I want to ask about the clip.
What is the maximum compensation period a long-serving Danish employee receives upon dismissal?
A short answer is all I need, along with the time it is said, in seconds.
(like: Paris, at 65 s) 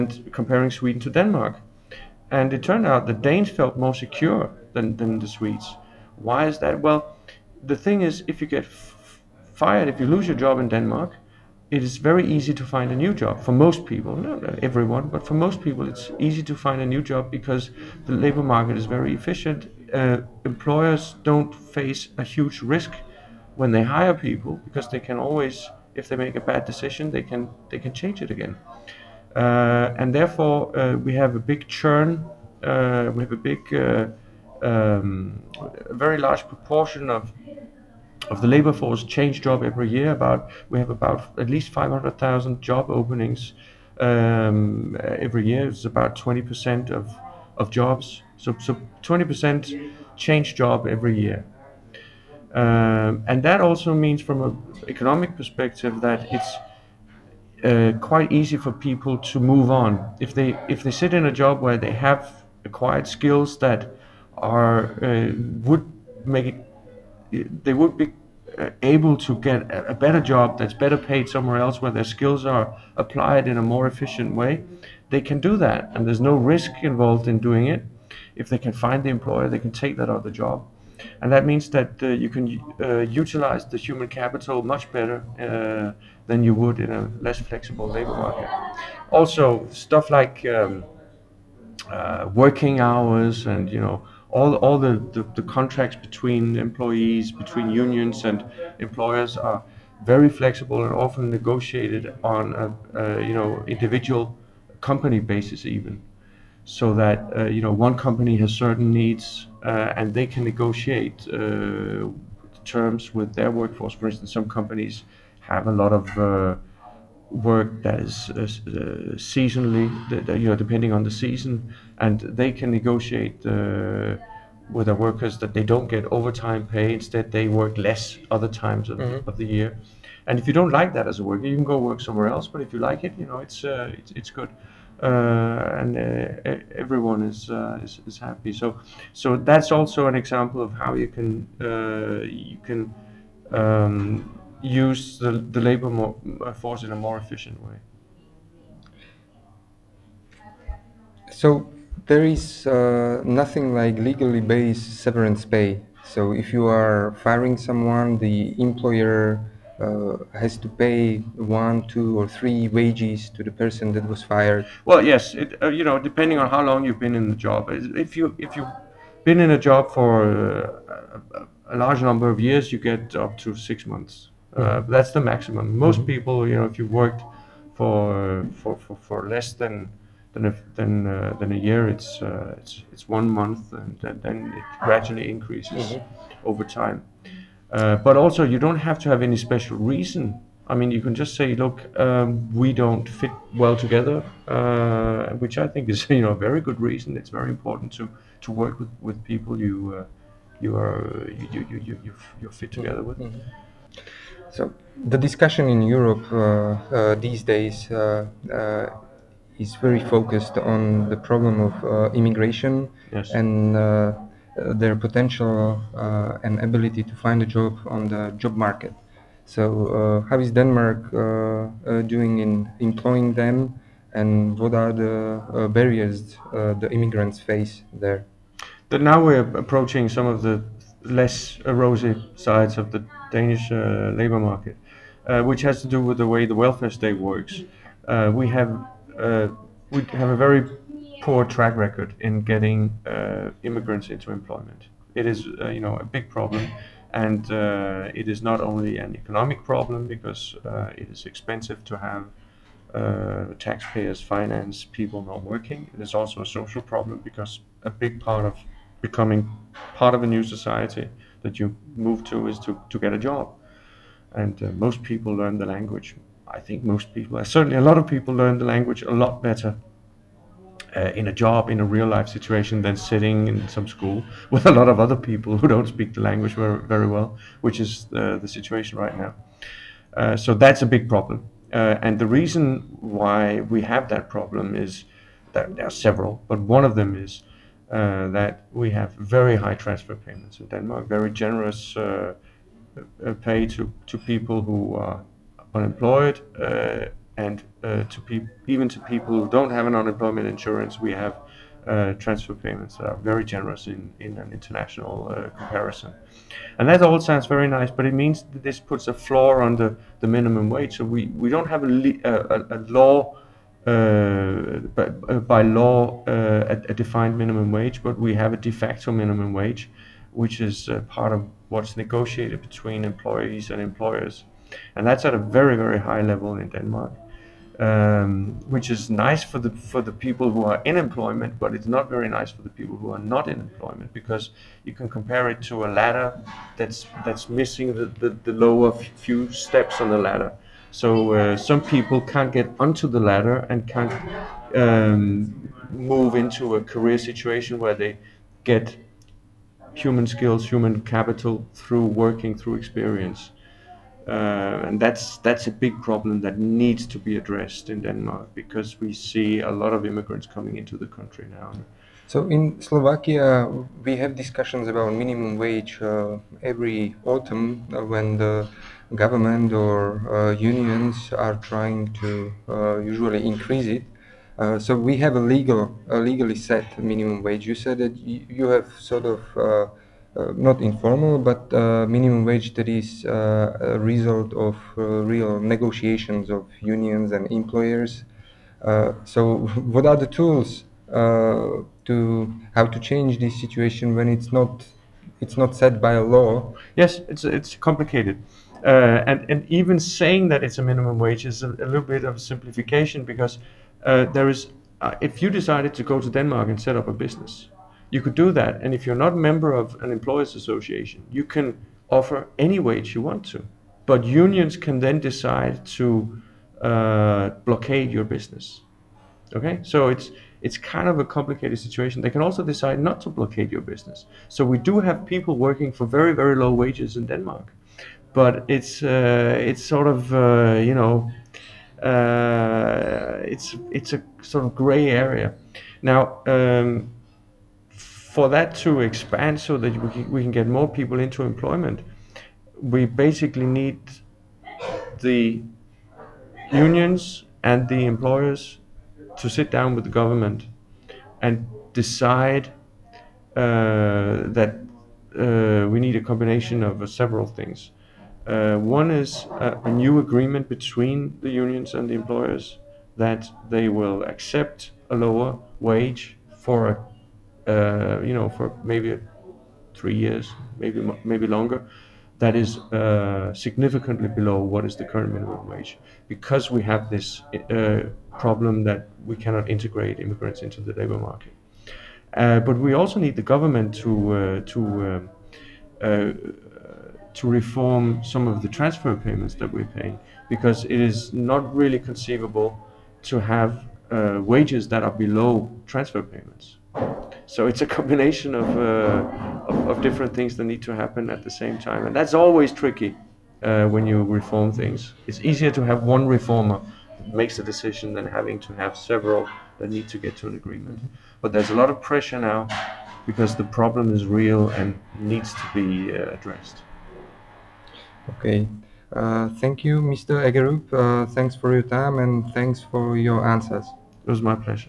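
6 months, at 173 s.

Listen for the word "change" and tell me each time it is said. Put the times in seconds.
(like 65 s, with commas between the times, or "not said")
27 s, 39 s, 50 s, 393 s.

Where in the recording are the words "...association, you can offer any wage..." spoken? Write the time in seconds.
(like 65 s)
410 s.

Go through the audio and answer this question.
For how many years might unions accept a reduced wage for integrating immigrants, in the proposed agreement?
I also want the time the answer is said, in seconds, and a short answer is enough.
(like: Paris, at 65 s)
3 years, at 470 s.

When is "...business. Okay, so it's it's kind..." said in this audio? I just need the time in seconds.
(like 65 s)
418 s.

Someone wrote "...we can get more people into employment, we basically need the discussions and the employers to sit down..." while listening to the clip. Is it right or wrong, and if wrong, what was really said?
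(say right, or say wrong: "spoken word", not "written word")
wrong: "unions", not "discussions".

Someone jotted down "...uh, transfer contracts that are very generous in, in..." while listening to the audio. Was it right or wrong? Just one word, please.
wrong.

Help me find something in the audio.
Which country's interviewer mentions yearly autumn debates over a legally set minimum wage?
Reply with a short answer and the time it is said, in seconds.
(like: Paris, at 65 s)
Slovakia, at 362 s.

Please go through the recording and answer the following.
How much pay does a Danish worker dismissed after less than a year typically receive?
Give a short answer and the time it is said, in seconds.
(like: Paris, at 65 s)
1 month, at 183 s.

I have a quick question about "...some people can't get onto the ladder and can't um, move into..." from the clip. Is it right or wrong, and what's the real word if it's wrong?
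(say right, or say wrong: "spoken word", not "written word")
right.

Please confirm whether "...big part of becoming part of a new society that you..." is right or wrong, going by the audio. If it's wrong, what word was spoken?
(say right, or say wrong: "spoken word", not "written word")
right.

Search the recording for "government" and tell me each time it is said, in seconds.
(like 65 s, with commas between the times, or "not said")
369 s, 450 s, 483 s.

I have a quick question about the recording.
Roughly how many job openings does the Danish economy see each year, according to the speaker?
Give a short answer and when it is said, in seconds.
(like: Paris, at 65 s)
500,000, at 41 s.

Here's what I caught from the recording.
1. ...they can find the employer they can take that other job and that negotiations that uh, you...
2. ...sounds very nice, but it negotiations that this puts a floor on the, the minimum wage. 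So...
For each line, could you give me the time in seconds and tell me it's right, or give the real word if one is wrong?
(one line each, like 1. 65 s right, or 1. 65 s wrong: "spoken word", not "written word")
1. 78 s wrong: "means", not "negotiations"
2. 307 s wrong: "means", not "negotiations".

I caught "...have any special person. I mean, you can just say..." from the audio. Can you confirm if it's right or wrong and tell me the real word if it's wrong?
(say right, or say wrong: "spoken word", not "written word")
wrong: "reason", not "person".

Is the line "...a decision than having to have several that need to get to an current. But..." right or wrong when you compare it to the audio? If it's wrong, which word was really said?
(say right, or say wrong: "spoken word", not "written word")
wrong: "agreement", not "current".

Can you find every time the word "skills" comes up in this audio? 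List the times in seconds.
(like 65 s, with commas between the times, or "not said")
63 s, 72 s, 350 s.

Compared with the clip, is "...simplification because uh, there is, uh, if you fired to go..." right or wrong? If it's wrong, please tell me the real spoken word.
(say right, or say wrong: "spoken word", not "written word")
wrong: "decided", not "fired".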